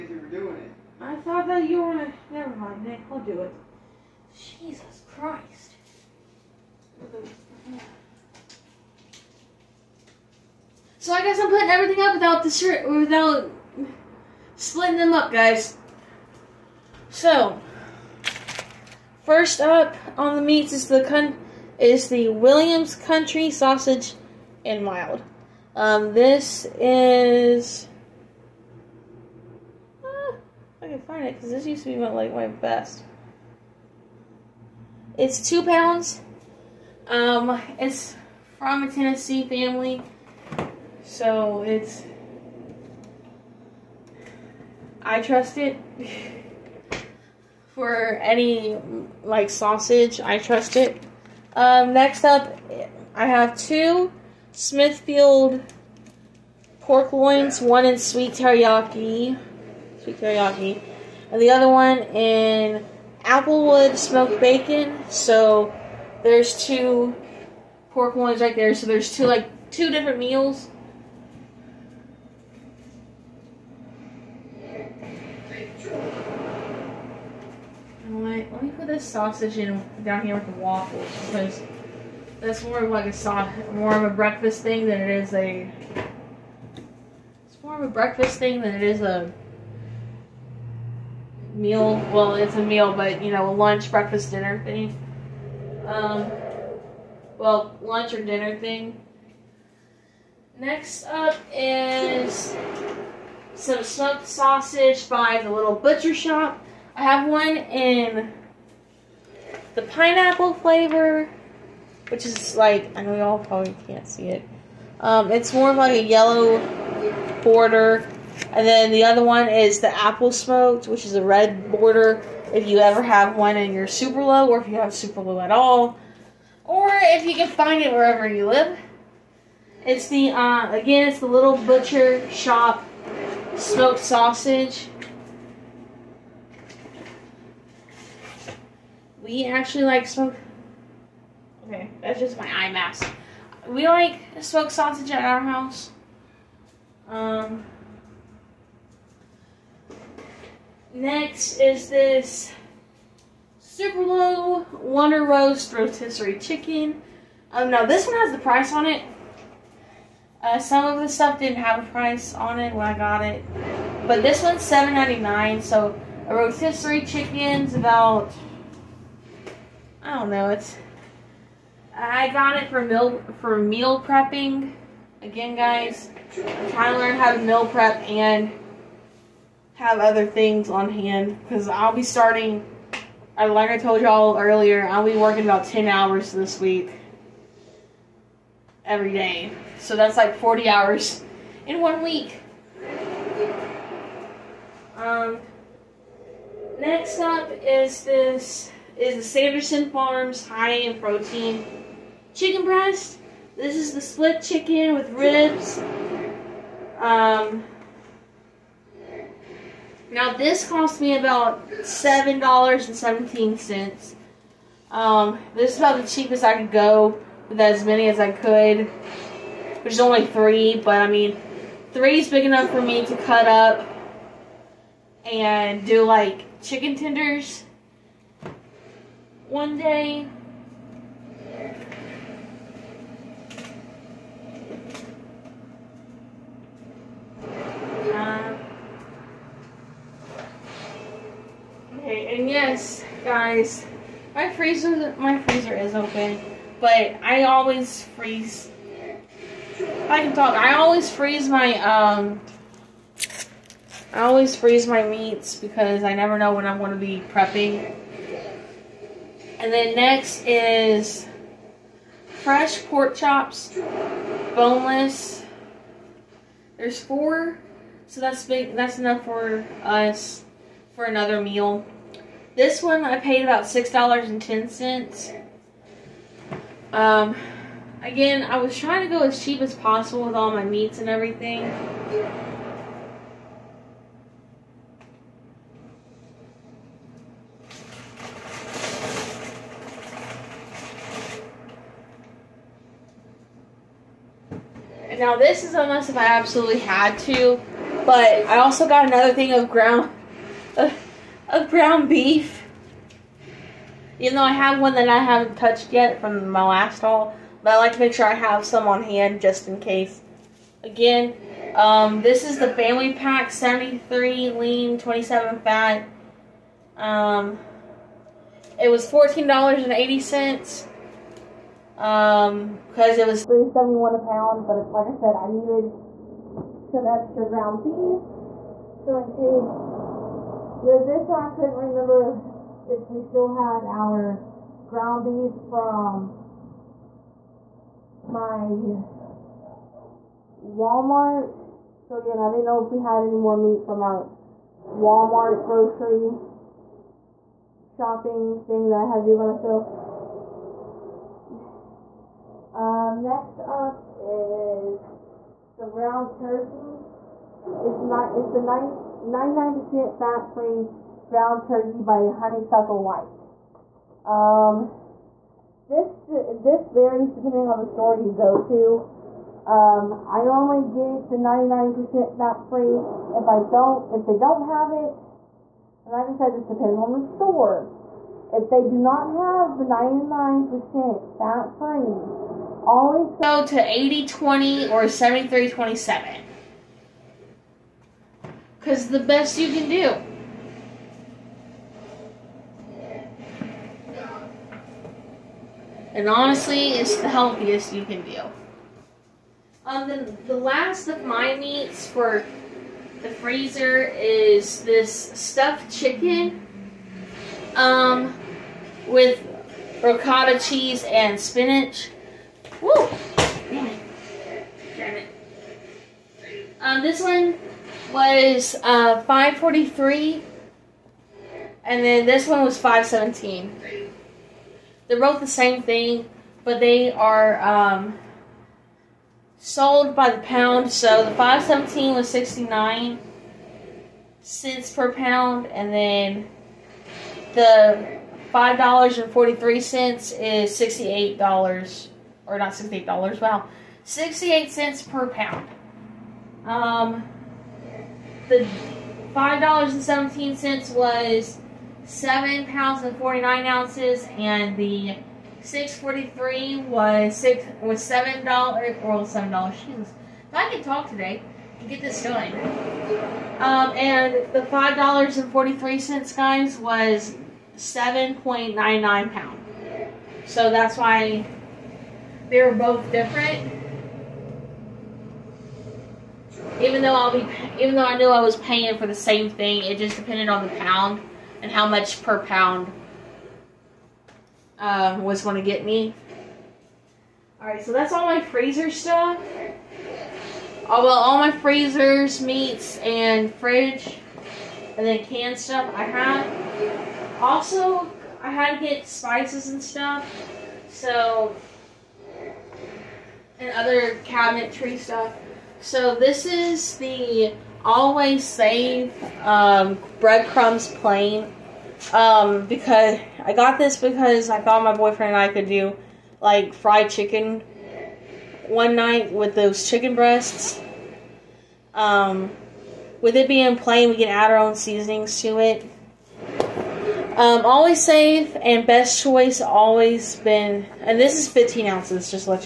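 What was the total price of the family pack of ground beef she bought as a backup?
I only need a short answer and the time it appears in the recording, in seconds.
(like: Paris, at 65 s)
$14.80, at 319 s.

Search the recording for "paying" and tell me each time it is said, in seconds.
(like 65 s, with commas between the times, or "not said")
478 s.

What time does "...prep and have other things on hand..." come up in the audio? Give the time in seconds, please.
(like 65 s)
177 s.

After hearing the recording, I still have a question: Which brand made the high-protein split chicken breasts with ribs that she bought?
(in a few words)
Sanderson Farms.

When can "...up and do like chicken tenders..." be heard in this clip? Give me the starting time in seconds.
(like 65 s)
223 s.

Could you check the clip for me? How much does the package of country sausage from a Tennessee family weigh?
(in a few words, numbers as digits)
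2 pounds.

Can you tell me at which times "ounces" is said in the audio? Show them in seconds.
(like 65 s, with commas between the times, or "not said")
453 s, 531 s.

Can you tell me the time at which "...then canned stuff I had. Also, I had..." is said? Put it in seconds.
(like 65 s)
495 s.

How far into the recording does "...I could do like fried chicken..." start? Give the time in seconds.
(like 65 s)
515 s.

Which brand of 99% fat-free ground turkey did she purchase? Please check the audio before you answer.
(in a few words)
Honeysuckle White.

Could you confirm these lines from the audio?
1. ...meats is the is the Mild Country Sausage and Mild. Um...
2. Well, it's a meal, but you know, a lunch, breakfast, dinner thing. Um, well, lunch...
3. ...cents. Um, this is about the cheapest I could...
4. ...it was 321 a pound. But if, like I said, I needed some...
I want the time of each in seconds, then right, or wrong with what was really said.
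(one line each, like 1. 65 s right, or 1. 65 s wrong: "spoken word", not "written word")
1. 20 s wrong: "Williams", not "Mild"
2. 92 s right
3. 213 s right
4. 323 s wrong: "371", not "321".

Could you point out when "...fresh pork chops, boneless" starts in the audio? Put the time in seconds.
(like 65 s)
262 s.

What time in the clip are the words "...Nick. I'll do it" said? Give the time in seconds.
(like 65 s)
2 s.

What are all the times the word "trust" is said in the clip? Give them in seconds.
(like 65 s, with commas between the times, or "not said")
45 s, 50 s.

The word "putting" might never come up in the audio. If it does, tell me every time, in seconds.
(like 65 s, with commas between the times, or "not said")
11 s.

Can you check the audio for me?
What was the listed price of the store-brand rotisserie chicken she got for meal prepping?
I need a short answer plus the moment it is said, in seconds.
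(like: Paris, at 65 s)
$7.99, at 164 s.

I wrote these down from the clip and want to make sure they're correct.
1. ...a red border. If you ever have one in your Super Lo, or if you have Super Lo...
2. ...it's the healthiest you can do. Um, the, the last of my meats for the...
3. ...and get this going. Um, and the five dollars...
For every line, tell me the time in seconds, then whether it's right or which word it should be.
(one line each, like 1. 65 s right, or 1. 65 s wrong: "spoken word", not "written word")
1. 121 s right
2. 396 s right
3. 461 s right.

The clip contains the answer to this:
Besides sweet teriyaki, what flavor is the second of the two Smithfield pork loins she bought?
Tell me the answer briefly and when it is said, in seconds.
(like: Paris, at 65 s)
Applewood smoked bacon, at 63 s.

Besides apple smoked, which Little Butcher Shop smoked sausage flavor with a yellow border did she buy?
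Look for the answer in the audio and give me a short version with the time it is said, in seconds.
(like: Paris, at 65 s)
Pineapple, at 109 s.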